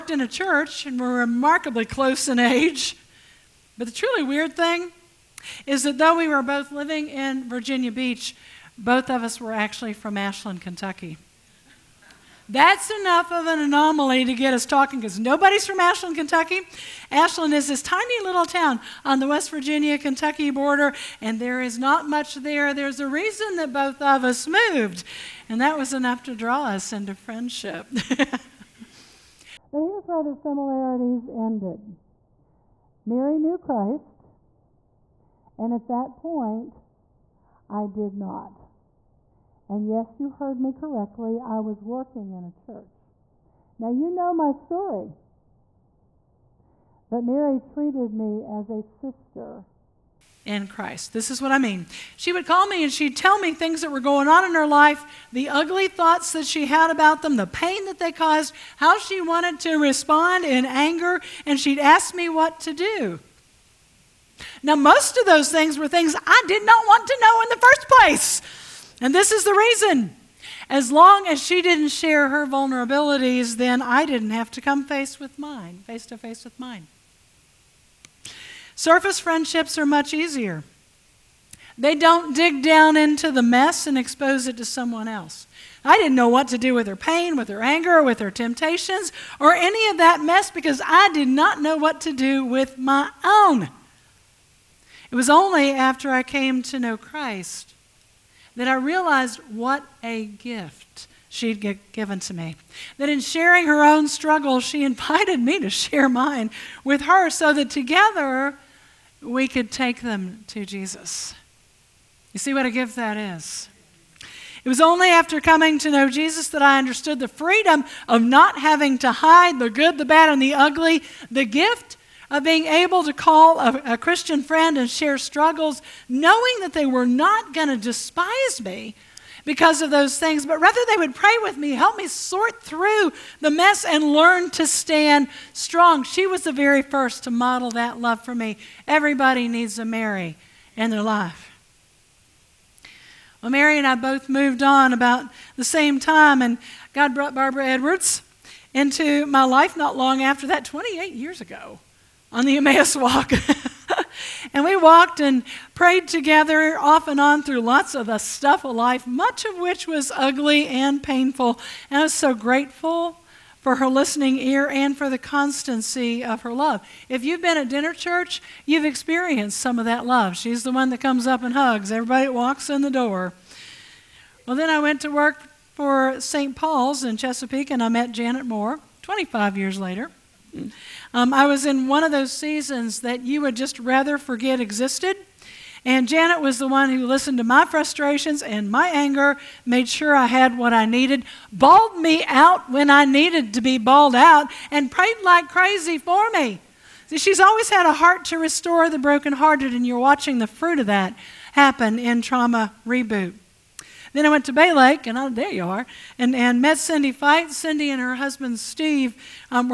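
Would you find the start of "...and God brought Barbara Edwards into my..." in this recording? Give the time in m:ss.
2:26.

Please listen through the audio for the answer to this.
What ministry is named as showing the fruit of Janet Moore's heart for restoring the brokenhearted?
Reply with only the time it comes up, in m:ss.
3:22.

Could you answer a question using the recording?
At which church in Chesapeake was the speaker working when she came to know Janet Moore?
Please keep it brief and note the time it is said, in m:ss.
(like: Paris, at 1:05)
St. Paul's, at 2:56.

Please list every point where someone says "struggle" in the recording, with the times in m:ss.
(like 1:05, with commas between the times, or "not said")
1:44, 2:05.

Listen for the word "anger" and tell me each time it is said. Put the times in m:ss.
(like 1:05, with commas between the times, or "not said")
1:00, 1:27, 3:08.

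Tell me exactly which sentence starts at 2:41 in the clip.
And I was so grateful for her listening ear and for the constancy of her love.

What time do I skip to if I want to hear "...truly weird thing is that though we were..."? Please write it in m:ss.
0:03.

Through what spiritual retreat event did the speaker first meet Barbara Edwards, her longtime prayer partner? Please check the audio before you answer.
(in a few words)
Emmaus walk.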